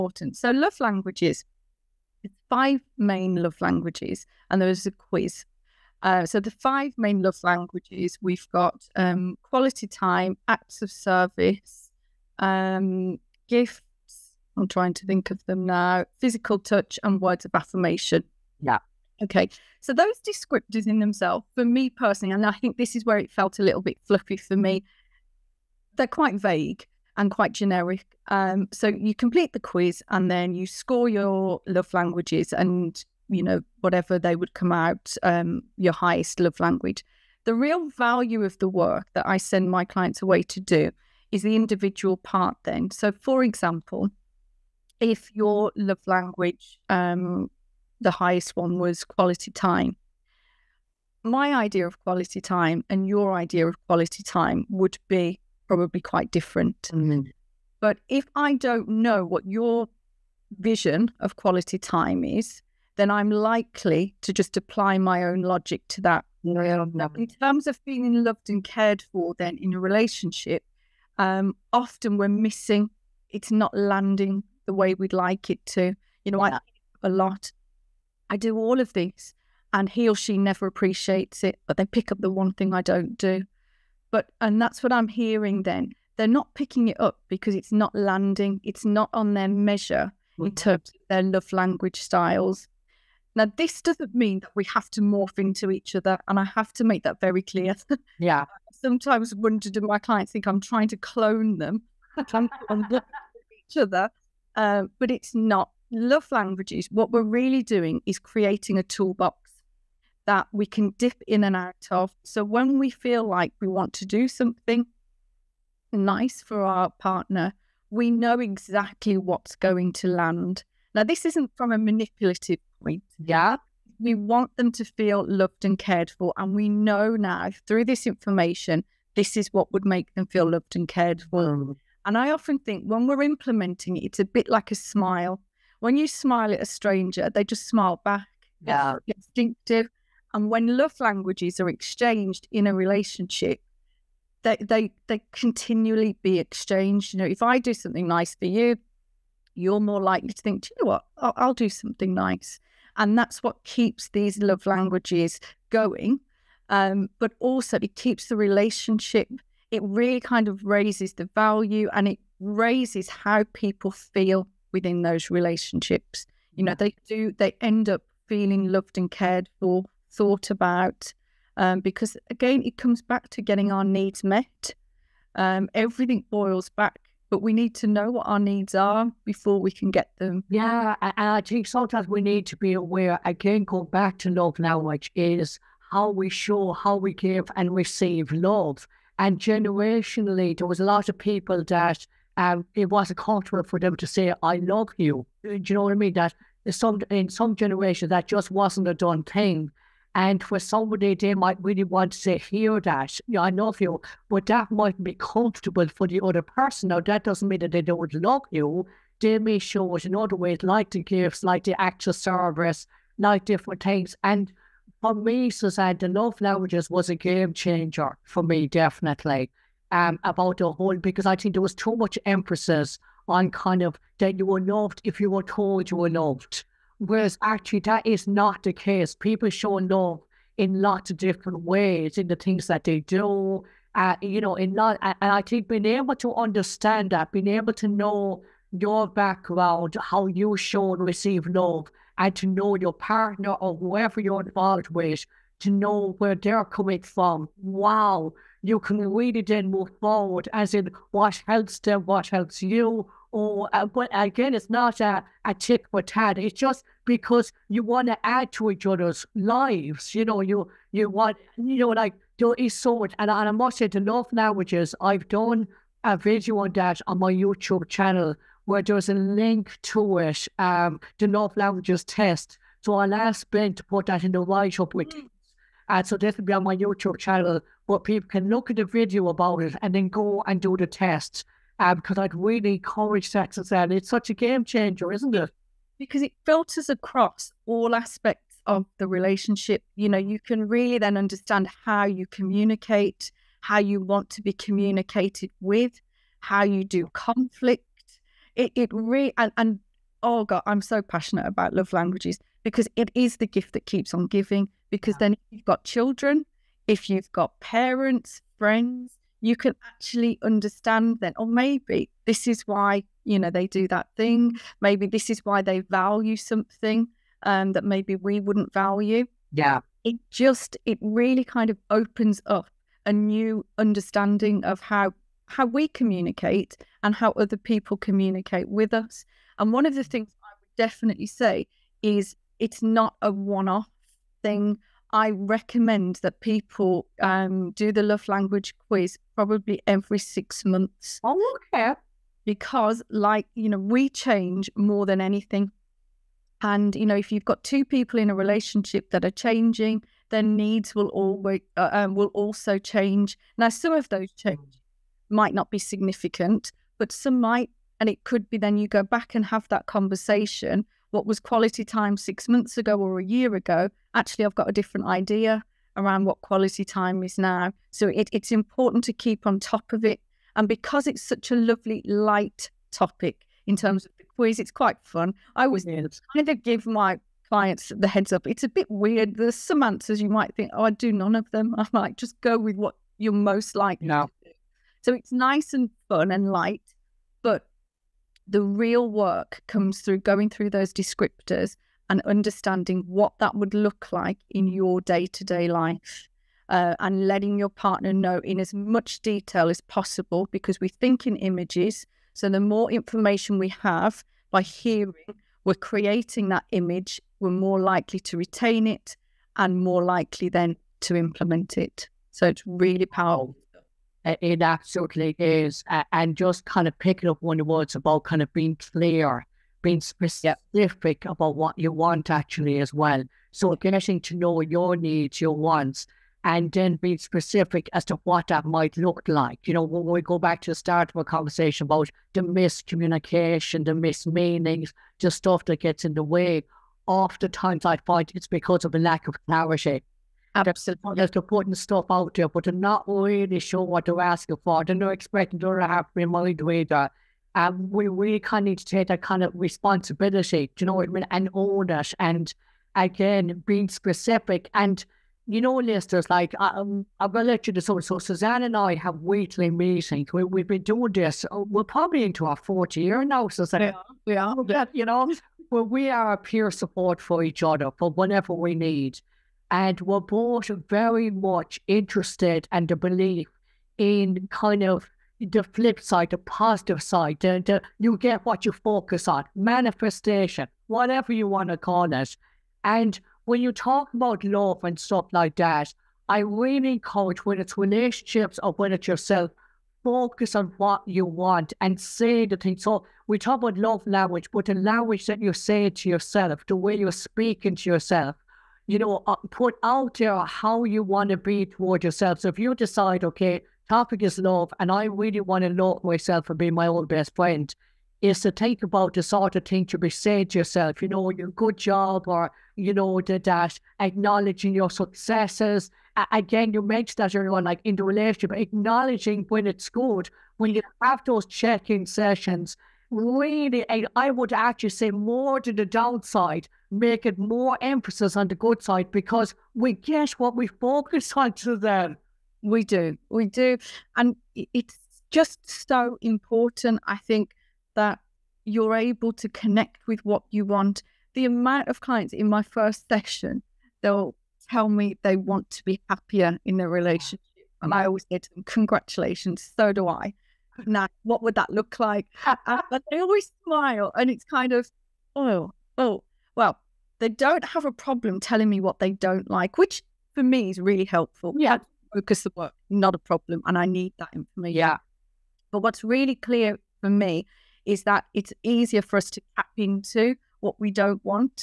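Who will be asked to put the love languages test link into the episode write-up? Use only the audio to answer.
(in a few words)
Ben.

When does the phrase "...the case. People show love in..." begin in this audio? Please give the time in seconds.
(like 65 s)
228 s.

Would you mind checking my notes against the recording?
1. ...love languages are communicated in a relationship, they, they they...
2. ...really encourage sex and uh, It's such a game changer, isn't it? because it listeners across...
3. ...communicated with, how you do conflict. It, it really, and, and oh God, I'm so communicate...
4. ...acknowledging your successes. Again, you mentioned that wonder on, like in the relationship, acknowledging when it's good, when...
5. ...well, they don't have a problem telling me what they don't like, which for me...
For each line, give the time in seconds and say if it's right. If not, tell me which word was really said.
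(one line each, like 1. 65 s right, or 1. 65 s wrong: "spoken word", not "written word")
1. 140 s wrong: "exchanged", not "communicated"
2. 282 s wrong: "filters", not "listeners"
3. 294 s wrong: "passionate", not "communicate"
4. 513 s wrong: "earlier", not "wonder"
5. 556 s right.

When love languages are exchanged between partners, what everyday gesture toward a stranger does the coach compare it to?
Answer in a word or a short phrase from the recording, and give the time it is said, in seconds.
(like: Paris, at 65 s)
A smile, at 134 s.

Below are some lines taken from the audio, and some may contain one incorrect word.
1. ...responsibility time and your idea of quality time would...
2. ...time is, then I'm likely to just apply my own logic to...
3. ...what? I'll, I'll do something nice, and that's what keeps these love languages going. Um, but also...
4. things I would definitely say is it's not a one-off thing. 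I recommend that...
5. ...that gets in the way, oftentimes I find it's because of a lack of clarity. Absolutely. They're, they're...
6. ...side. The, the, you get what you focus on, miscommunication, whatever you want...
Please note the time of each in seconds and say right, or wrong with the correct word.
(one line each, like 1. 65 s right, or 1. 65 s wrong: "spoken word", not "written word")
1. 52 s wrong: "quality", not "responsibility"
2. 61 s right
3. 150 s right
4. 330 s right
5. 435 s right
6. 477 s wrong: "manifestation", not "miscommunication".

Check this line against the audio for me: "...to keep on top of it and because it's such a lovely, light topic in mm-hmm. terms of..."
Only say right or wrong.
right.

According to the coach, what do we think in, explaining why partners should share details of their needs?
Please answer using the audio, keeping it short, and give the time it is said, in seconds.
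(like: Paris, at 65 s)
Images, at 401 s.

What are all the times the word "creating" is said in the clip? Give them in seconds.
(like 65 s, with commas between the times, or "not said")
108 s, 405 s.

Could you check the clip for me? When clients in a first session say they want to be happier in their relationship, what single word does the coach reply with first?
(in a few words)
Congratulations.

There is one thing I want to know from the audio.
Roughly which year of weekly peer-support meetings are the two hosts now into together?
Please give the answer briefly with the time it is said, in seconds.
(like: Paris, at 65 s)
Fourth year, at 462 s.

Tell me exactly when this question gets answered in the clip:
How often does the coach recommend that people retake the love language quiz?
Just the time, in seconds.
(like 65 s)
339 s.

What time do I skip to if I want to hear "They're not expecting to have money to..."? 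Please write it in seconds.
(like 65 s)
444 s.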